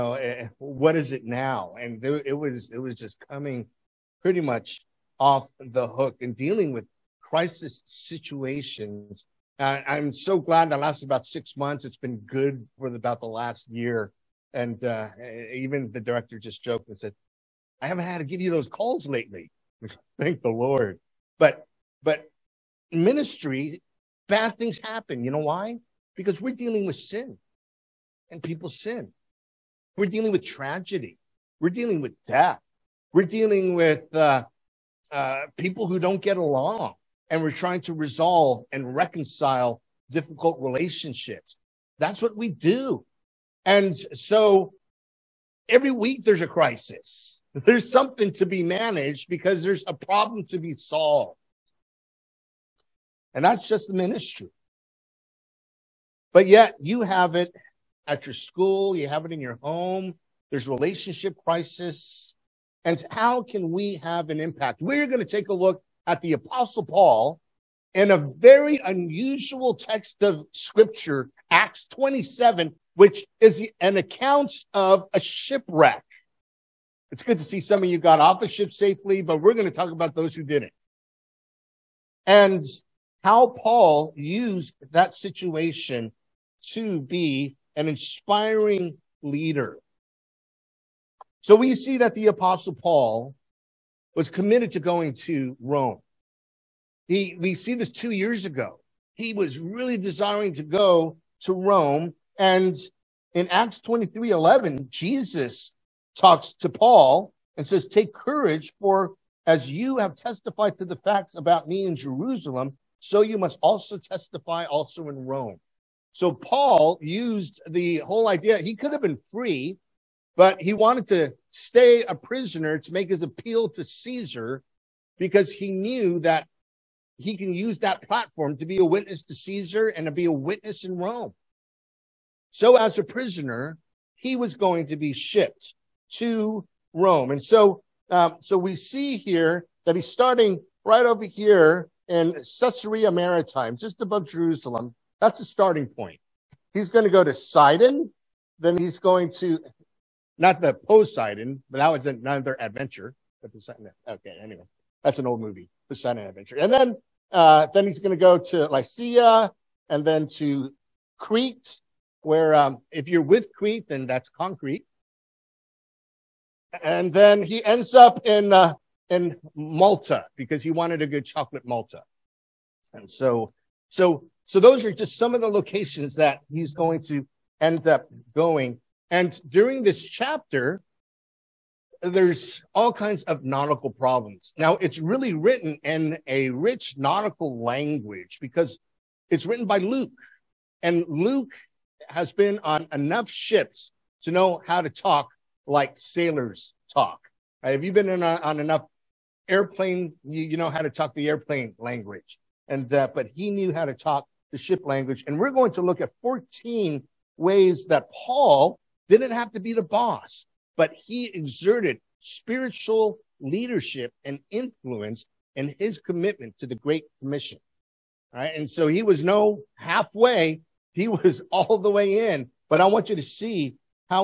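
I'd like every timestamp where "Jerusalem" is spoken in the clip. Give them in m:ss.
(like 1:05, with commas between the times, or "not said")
1:51, 2:24.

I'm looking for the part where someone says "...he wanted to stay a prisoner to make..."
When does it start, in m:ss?
2:00.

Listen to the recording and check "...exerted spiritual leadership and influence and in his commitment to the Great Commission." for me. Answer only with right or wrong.
right.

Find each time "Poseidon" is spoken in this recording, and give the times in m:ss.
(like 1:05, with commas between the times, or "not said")
2:30, 2:35.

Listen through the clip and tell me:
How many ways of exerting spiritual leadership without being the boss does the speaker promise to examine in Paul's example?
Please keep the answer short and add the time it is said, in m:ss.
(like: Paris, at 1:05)
14, at 3:26.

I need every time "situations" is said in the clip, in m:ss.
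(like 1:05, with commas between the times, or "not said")
0:07, 1:25.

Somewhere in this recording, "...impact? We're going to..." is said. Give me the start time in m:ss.
1:04.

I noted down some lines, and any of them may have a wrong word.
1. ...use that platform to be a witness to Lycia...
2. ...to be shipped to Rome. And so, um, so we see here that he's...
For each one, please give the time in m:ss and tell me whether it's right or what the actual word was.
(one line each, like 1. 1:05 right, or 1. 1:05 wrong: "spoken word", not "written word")
1. 2:07 wrong: "Caesar", not "Lycia"
2. 2:14 right.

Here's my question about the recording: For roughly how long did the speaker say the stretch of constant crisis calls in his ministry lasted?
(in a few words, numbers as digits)
6 months.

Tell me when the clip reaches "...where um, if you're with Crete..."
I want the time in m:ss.
2:42.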